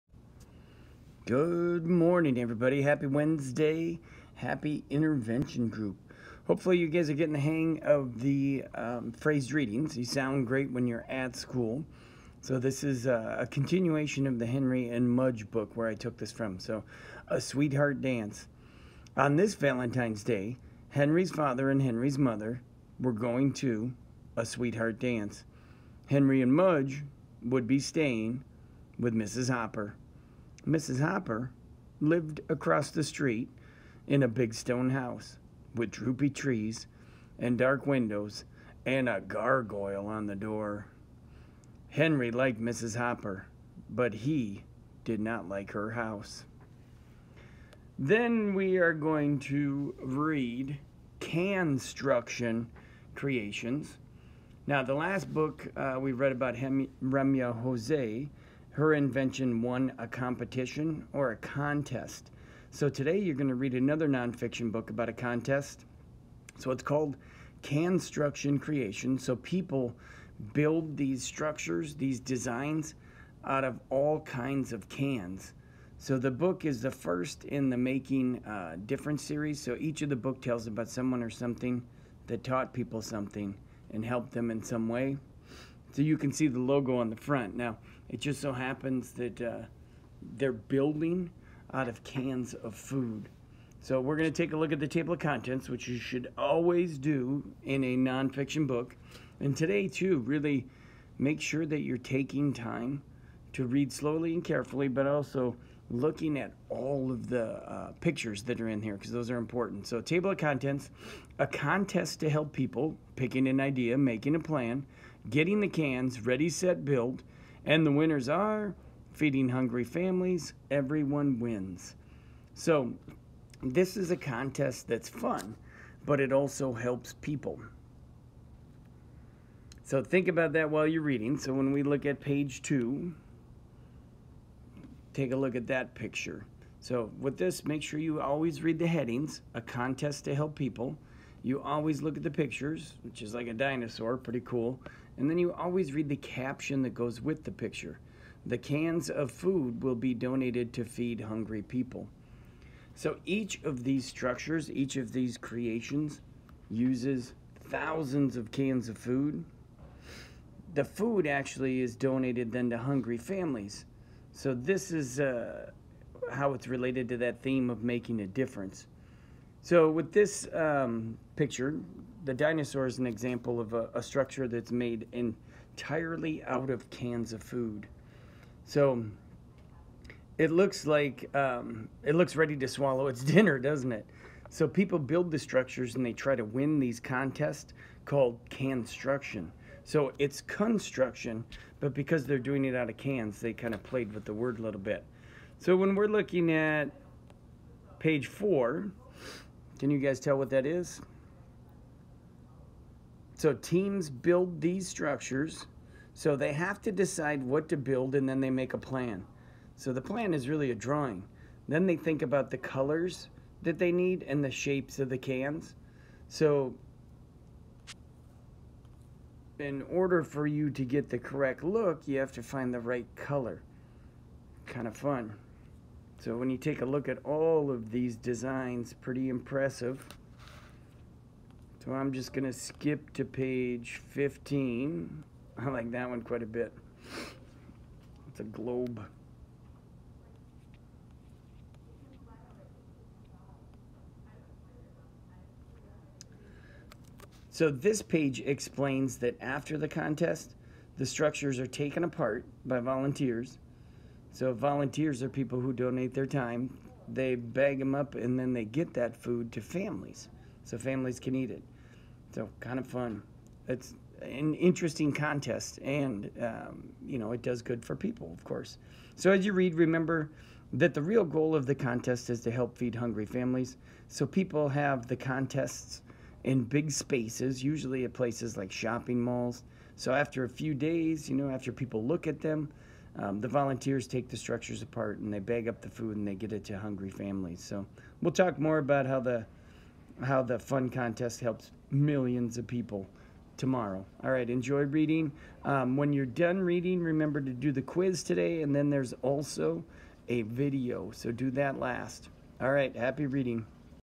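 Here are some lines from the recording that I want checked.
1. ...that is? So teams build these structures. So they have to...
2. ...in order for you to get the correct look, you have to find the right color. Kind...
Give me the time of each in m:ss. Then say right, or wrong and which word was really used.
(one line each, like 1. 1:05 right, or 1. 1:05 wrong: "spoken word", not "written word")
1. 3:20 right
2. 3:39 right.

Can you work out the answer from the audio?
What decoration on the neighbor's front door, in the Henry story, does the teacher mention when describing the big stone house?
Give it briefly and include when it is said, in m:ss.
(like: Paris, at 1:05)
A gargoyle, at 0:39.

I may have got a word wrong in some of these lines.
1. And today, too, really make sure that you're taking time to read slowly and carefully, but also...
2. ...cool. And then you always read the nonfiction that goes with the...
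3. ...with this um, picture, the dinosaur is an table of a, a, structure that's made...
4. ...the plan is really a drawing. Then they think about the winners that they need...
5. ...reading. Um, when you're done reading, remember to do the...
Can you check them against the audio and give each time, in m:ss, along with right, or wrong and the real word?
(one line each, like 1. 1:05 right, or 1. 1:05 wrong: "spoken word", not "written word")
1. 1:39 right
2. 2:24 wrong: "caption", not "nonfiction"
3. 2:49 wrong: "example", not "table"
4. 3:29 wrong: "colors", not "winners"
5. 4:54 right.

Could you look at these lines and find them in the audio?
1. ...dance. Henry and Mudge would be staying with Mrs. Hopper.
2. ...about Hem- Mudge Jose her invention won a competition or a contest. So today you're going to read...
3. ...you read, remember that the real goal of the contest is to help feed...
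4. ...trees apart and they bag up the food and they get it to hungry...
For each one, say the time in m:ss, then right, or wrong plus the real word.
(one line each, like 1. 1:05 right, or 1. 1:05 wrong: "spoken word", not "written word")
1. 0:24 right
2. 0:56 wrong: "Remya", not "Mudge"
3. 4:29 right
4. 4:44 wrong: "structures", not "trees".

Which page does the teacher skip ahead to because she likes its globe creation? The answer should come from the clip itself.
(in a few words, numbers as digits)
15.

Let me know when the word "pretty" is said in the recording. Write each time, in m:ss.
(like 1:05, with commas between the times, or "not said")
2:24, 3:49.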